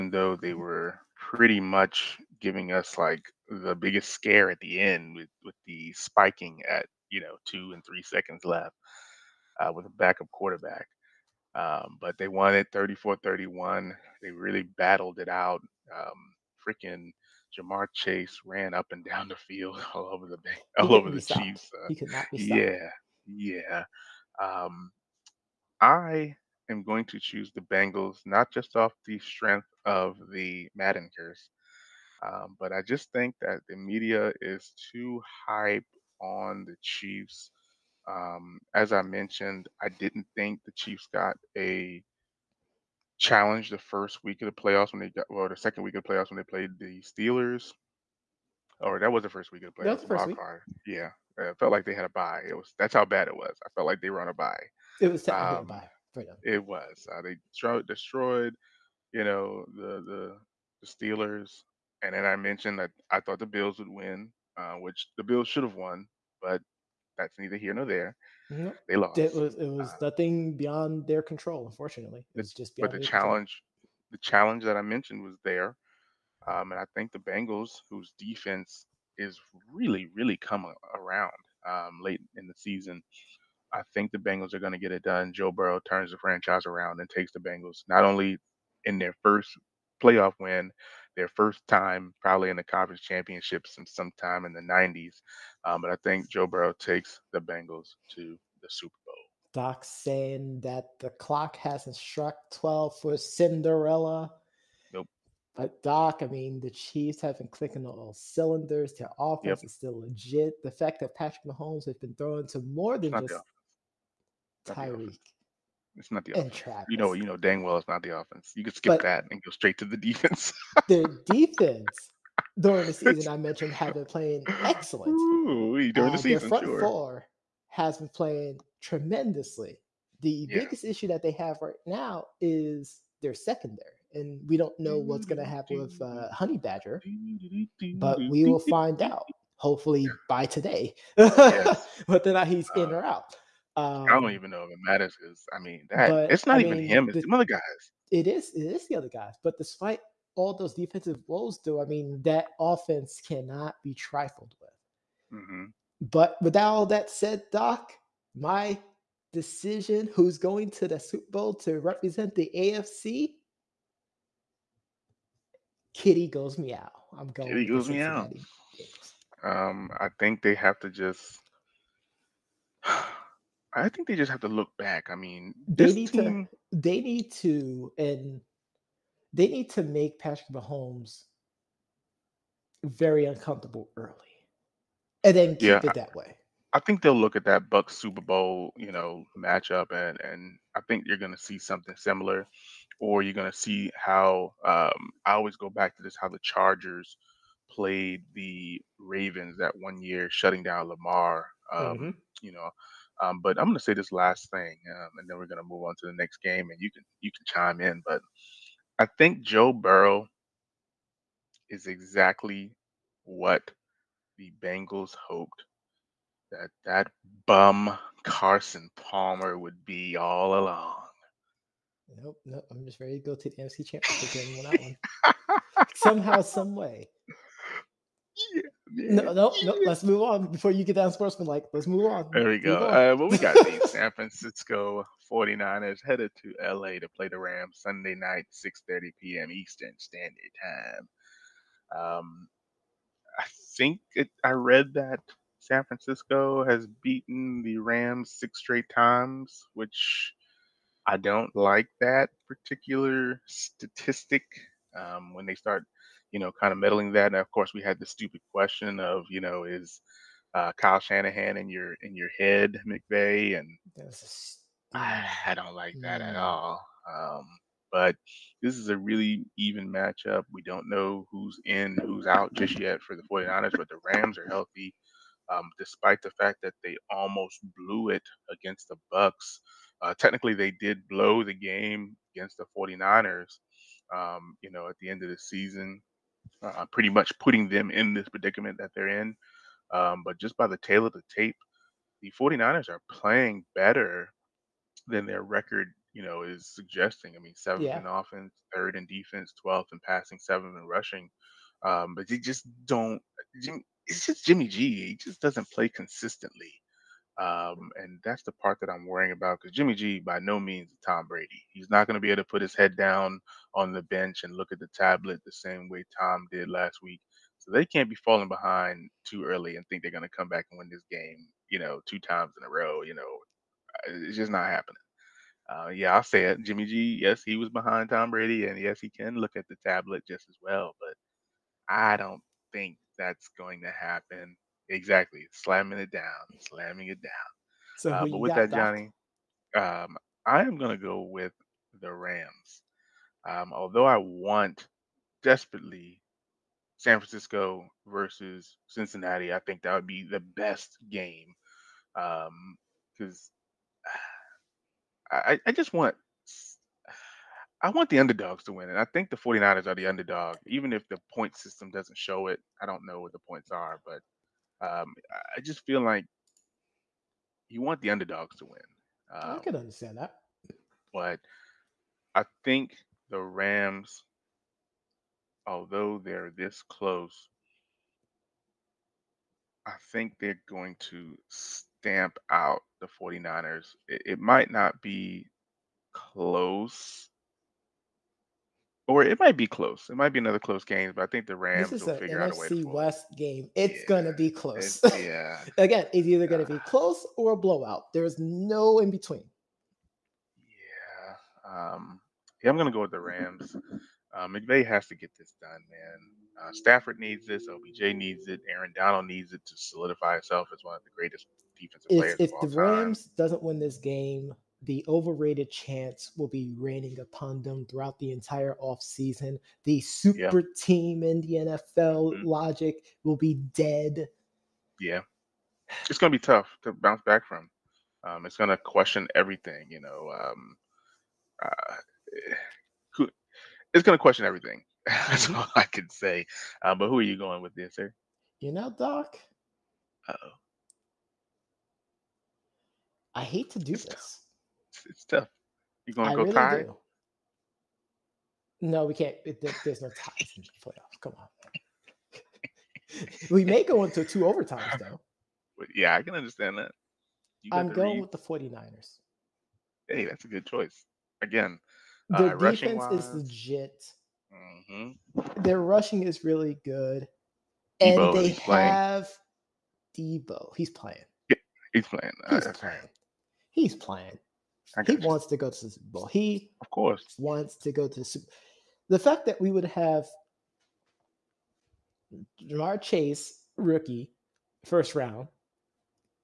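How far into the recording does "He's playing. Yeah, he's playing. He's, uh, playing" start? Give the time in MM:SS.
07:50.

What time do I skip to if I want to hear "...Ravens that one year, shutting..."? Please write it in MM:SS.
03:18.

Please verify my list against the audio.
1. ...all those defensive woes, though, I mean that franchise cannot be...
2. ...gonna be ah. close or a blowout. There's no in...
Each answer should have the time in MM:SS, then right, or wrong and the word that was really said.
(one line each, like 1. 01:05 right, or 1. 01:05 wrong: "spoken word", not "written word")
1. 02:30 wrong: "offense", not "franchise"
2. 06:36 right.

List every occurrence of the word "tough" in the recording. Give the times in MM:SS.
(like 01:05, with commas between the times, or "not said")
07:06, 07:25.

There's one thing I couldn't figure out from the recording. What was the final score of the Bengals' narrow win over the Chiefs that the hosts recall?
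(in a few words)
34-31.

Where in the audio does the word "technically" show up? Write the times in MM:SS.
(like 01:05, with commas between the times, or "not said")
00:55, 04:40.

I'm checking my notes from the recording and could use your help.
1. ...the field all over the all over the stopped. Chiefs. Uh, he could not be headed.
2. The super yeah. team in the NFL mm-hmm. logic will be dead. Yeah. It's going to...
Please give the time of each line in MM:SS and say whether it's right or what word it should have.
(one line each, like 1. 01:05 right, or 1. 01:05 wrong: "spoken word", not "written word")
1. 00:19 wrong: "stopped", not "headed"
2. 06:59 right.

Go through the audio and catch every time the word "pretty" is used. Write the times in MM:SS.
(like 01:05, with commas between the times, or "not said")
00:01, 04:46.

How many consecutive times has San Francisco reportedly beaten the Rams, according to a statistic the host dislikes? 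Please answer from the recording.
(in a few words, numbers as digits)
6.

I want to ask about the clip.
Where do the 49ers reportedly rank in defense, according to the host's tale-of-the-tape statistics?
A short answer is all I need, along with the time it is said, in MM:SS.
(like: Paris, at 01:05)
third, at 04:58.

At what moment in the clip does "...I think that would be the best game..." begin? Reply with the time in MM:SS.
05:49.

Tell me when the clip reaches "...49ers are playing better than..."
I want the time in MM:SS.
04:52.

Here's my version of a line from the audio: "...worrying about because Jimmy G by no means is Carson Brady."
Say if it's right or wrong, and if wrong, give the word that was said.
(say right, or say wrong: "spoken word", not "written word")
wrong: "Tom", not "Carson".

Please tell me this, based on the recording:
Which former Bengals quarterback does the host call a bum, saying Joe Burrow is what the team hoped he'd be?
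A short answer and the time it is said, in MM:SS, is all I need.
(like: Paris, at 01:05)
Carson Palmer, at 03:38.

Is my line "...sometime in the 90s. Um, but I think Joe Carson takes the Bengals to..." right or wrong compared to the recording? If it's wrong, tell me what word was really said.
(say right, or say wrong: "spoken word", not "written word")
wrong: "Burrow", not "Carson".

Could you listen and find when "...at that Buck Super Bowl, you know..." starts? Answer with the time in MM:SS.
03:07.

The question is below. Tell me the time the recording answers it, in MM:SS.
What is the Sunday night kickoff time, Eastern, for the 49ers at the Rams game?
03:58.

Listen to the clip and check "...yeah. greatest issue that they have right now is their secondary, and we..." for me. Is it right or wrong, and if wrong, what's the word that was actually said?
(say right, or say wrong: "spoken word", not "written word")
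wrong: "biggest", not "greatest".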